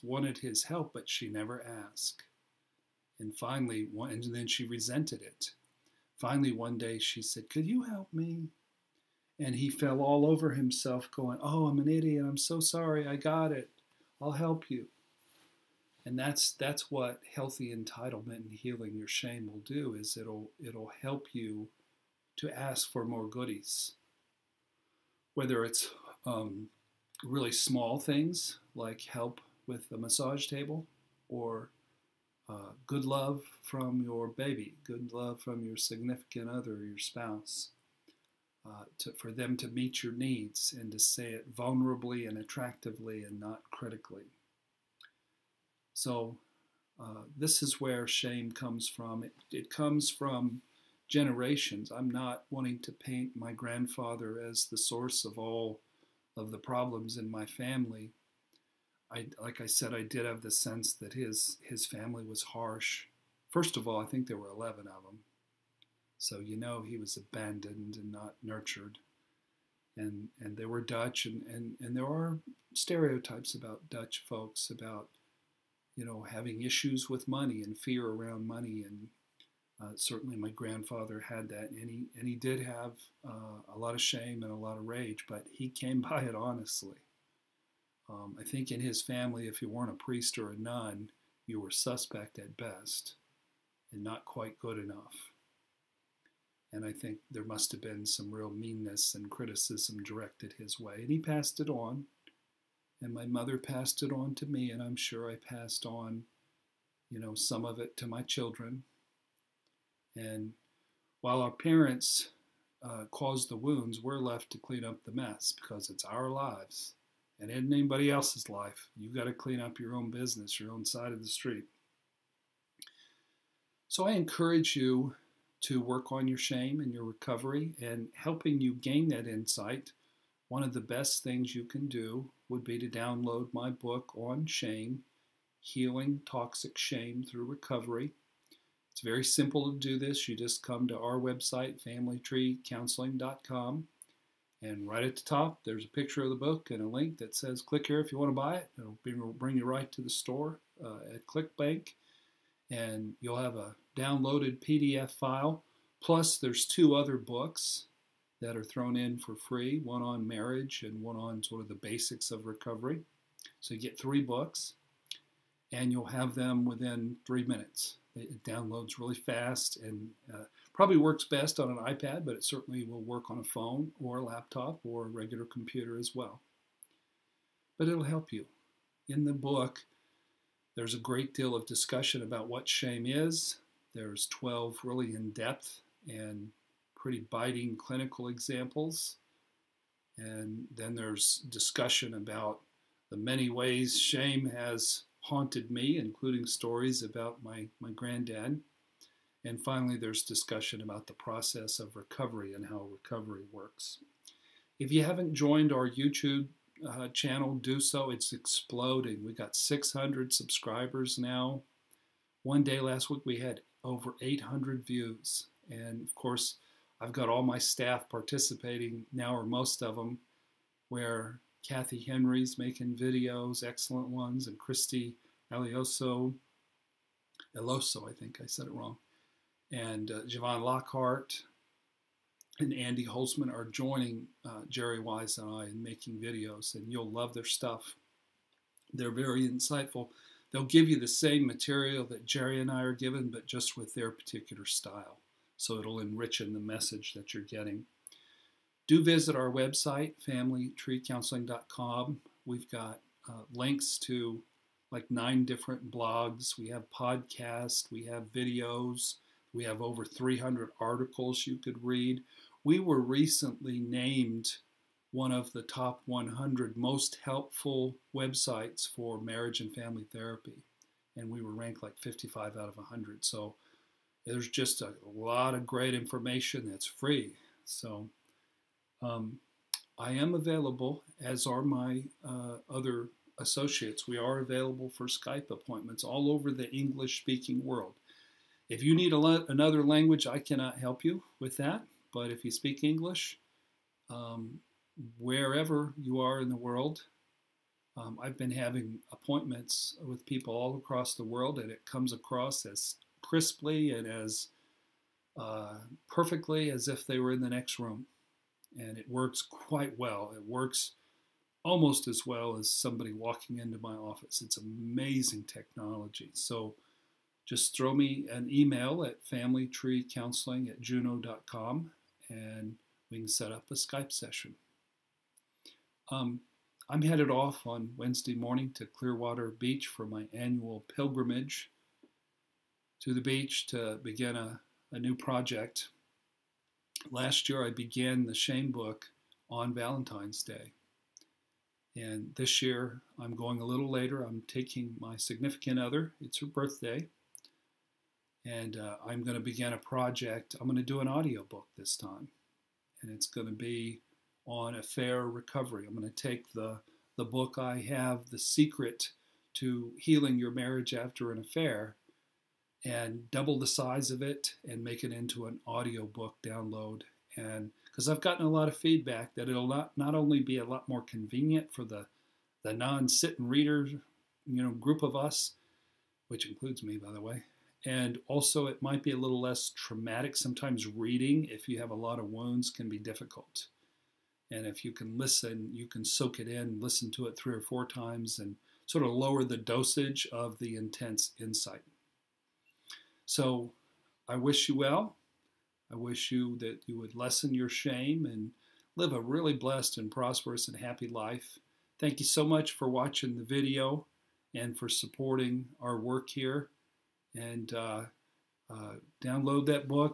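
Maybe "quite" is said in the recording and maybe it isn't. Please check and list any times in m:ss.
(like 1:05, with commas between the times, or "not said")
1:34, 5:09.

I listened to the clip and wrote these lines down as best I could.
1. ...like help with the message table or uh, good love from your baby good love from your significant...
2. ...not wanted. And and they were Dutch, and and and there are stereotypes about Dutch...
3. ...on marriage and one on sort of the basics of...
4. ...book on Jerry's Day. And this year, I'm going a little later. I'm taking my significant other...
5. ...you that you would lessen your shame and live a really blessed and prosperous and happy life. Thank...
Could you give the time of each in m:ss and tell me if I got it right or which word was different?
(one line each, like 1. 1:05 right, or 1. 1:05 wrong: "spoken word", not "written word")
1. 0:28 wrong: "massage", not "message"
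2. 1:08 wrong: "nurtured", not "wanted"
3. 2:40 right
4. 5:38 wrong: "Valentine", not "Jerry"
5. 6:36 right.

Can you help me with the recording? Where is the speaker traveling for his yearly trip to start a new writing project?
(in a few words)
Clearwater Beach.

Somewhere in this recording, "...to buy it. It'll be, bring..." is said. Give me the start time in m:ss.
2:28.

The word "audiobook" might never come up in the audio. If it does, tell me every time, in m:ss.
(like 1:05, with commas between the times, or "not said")
5:51, 6:05.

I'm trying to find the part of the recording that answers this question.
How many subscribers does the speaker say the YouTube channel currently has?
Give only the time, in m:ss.
3:29.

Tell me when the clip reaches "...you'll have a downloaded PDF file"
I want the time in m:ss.
2:33.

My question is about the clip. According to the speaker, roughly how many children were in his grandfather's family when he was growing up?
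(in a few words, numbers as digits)
11.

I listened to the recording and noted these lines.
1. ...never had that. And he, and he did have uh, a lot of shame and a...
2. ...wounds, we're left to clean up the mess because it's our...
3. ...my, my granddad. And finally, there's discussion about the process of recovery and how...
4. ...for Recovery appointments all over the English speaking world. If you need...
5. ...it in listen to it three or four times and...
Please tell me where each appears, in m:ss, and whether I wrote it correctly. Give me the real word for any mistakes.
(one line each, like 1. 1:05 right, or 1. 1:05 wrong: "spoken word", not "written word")
1. 1:20 wrong: "grandfather", not "never"
2. 1:53 right
3. 3:17 right
4. 4:44 wrong: "Skype", not "Recovery"
5. 6:26 right.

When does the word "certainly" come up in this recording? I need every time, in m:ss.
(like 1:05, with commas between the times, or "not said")
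1:19, 2:52.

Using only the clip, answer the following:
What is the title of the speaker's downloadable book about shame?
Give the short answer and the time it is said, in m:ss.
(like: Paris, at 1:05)
Healing Toxic Shame Through Recovery, at 2:15.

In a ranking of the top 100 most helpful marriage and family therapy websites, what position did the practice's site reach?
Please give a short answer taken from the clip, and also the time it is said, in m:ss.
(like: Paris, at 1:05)
55, at 4:31.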